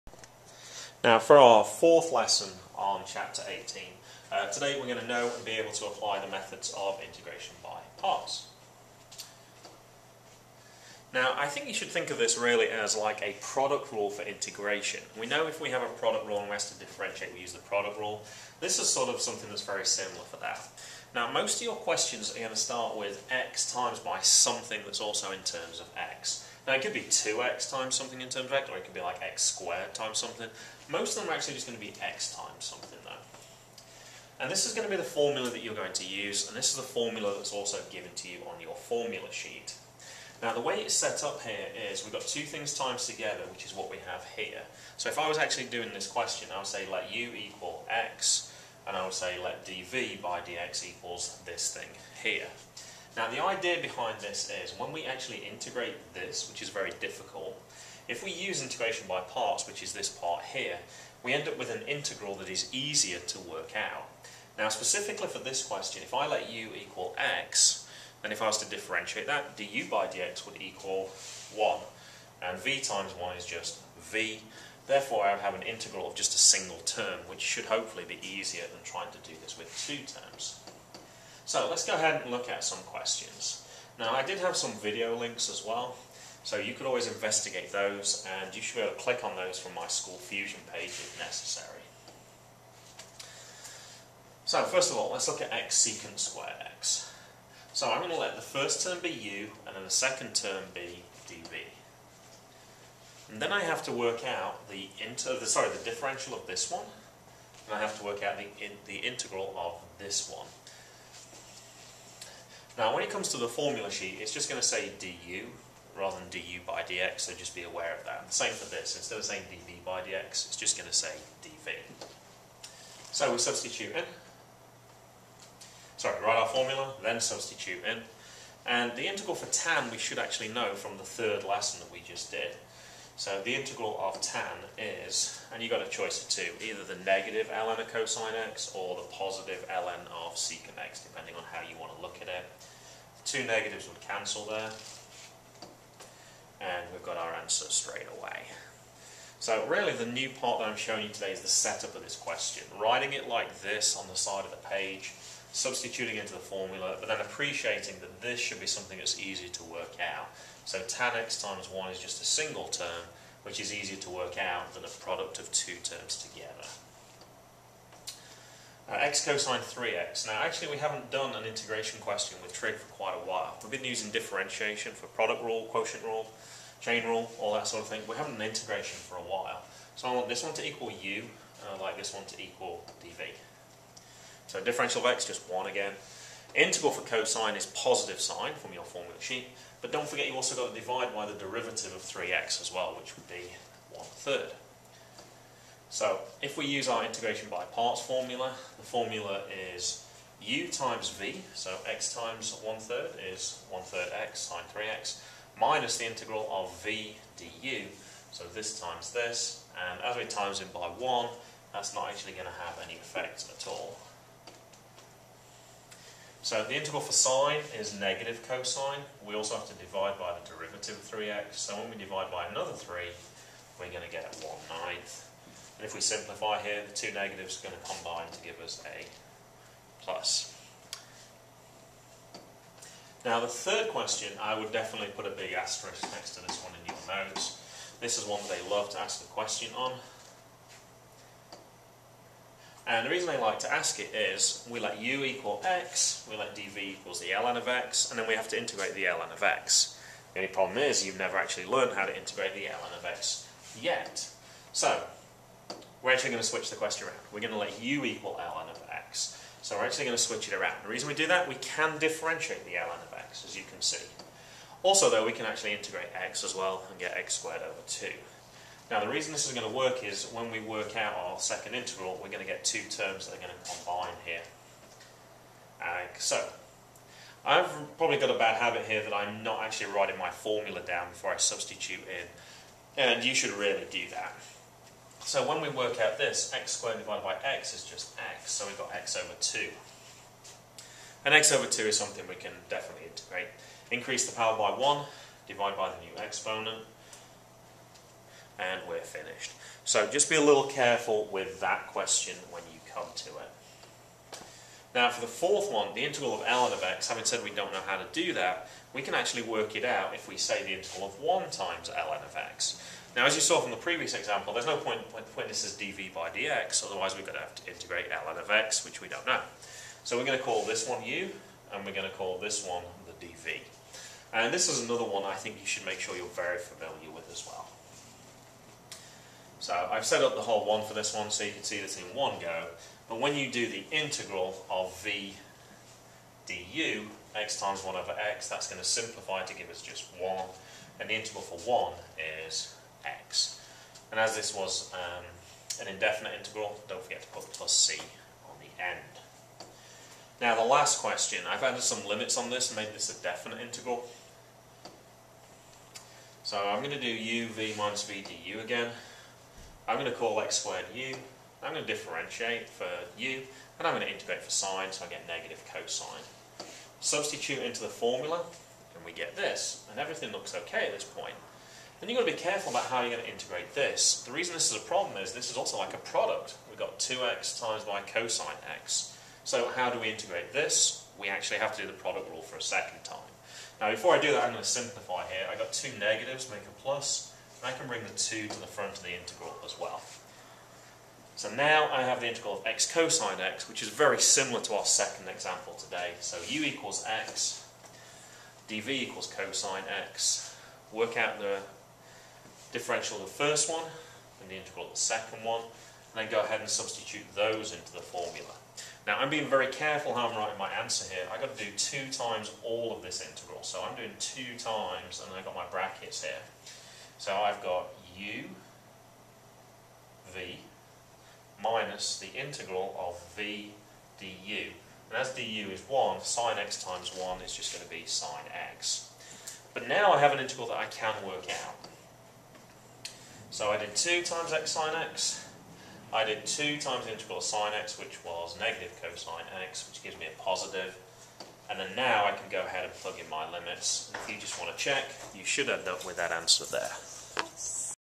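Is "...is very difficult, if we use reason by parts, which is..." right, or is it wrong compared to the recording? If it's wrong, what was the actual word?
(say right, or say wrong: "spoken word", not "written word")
wrong: "integration", not "reason".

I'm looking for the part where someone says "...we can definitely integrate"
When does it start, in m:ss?
4:52.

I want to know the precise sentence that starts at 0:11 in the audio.
Now I think you should think of this really as like a product rule for integration.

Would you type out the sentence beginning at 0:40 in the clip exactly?
Now the way it's set up here is we've got two things times together, which is what we have here.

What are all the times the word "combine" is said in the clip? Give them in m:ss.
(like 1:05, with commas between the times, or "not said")
3:47, 4:33.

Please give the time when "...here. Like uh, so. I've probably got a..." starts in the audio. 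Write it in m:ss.
4:34.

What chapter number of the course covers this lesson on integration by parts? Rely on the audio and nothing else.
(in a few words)
18.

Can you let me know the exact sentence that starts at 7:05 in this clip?
And as du is 1, sine x times 1 is just going to be sine x.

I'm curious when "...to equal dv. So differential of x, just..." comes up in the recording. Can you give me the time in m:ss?
3:02.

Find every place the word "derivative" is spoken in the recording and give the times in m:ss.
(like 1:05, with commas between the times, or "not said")
3:11, 3:40.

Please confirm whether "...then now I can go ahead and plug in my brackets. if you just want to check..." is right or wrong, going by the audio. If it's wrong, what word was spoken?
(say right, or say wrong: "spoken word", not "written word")
wrong: "limits", not "brackets".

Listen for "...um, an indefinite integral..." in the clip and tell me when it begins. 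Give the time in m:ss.
5:44.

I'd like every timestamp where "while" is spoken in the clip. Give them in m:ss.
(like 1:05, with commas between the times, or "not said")
2:53, 2:59.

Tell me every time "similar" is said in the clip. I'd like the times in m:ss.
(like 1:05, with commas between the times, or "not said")
0:19, 6:34.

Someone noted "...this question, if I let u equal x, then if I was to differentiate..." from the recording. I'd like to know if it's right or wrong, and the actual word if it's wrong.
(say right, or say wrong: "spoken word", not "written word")
right.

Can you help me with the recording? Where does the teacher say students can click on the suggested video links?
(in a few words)
School Fusion page.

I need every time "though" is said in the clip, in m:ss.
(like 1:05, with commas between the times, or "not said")
0:33, 4:25.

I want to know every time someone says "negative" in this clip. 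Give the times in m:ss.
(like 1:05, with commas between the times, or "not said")
2:17, 2:23, 3:37, 3:47, 6:05, 6:25, 7:18.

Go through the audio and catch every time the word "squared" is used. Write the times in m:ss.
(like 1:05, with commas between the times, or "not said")
0:29, 1:36, 4:27, 4:46, 6:00.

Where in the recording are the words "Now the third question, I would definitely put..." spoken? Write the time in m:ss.
3:53.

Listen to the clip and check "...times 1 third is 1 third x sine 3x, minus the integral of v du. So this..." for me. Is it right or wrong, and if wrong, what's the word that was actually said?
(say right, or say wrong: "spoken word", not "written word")
right.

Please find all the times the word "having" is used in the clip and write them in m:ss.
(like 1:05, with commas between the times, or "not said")
2:58, 5:07.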